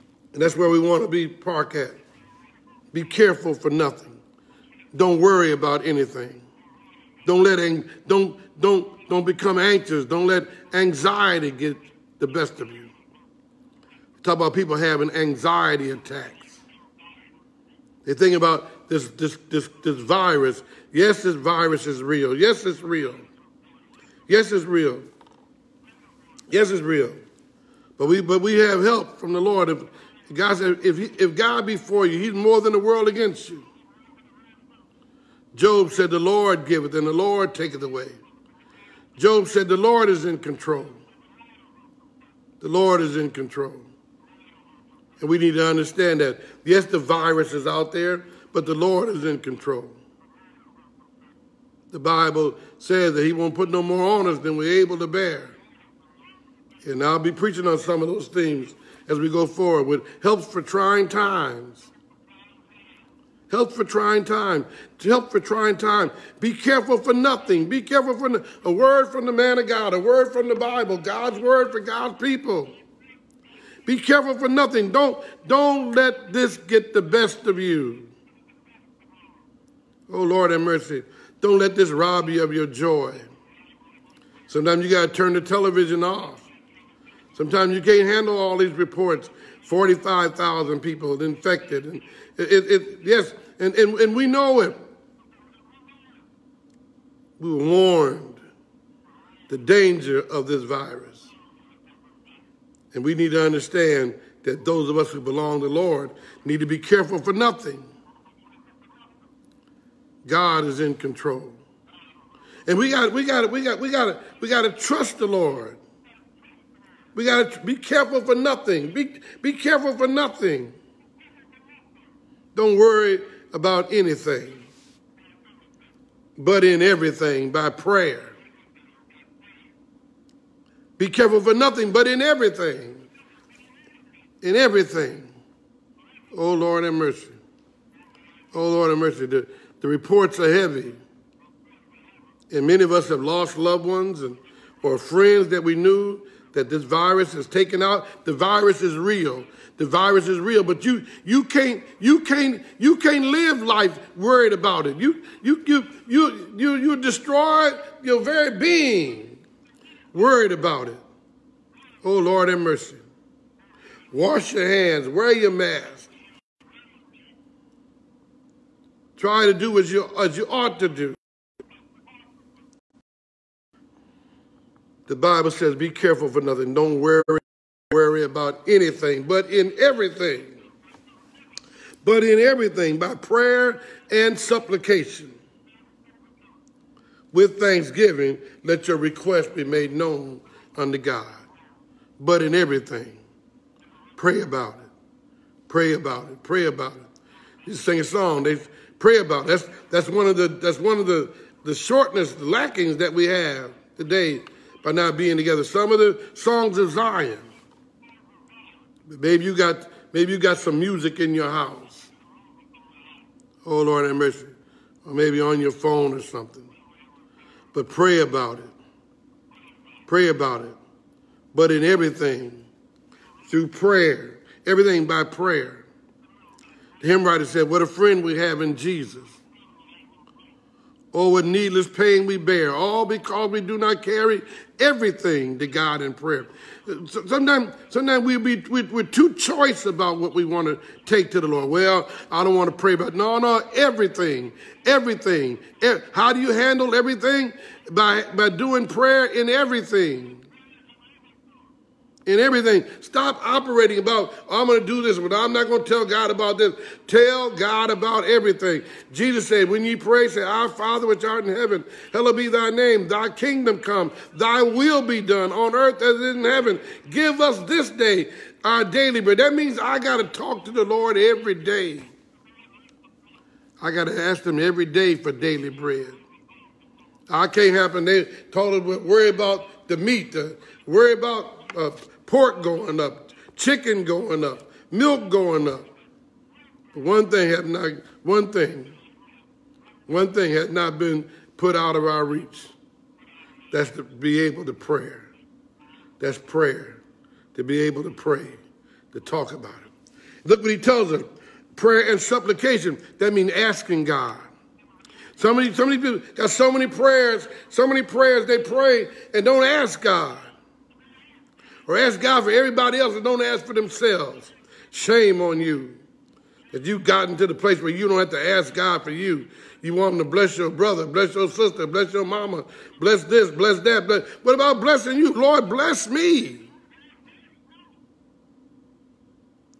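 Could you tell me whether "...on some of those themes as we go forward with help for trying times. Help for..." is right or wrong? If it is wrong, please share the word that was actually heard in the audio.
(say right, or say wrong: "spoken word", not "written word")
right.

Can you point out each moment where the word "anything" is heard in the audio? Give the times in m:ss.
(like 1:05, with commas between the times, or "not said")
0:05, 2:03, 2:58.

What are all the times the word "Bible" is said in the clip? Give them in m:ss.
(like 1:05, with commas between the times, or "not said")
0:52, 1:10, 2:55.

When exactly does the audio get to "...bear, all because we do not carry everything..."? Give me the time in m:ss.
3:52.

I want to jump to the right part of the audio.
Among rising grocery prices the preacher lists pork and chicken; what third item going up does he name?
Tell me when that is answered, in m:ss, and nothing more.
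4:44.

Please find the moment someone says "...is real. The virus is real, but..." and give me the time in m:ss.
2:28.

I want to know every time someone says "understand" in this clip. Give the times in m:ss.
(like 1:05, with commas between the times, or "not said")
0:45, 1:43.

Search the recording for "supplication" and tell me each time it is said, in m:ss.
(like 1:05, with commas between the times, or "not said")
3:04, 5:02.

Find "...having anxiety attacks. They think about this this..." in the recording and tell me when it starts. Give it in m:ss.
0:14.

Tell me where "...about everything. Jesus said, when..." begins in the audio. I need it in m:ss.
4:17.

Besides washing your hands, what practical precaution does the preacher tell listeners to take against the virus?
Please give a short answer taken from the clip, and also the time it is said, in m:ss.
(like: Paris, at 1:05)
wear your mask, at 2:45.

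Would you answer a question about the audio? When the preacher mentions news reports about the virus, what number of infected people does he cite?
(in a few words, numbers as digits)
45,000.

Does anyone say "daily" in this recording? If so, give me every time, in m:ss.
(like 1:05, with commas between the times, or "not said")
4:28, 4:35.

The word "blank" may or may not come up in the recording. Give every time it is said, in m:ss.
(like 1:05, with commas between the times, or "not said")
not said.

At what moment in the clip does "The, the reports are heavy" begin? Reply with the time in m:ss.
2:19.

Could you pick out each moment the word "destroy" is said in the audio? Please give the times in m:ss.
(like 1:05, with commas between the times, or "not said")
2:36.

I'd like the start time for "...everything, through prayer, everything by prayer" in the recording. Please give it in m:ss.
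3:41.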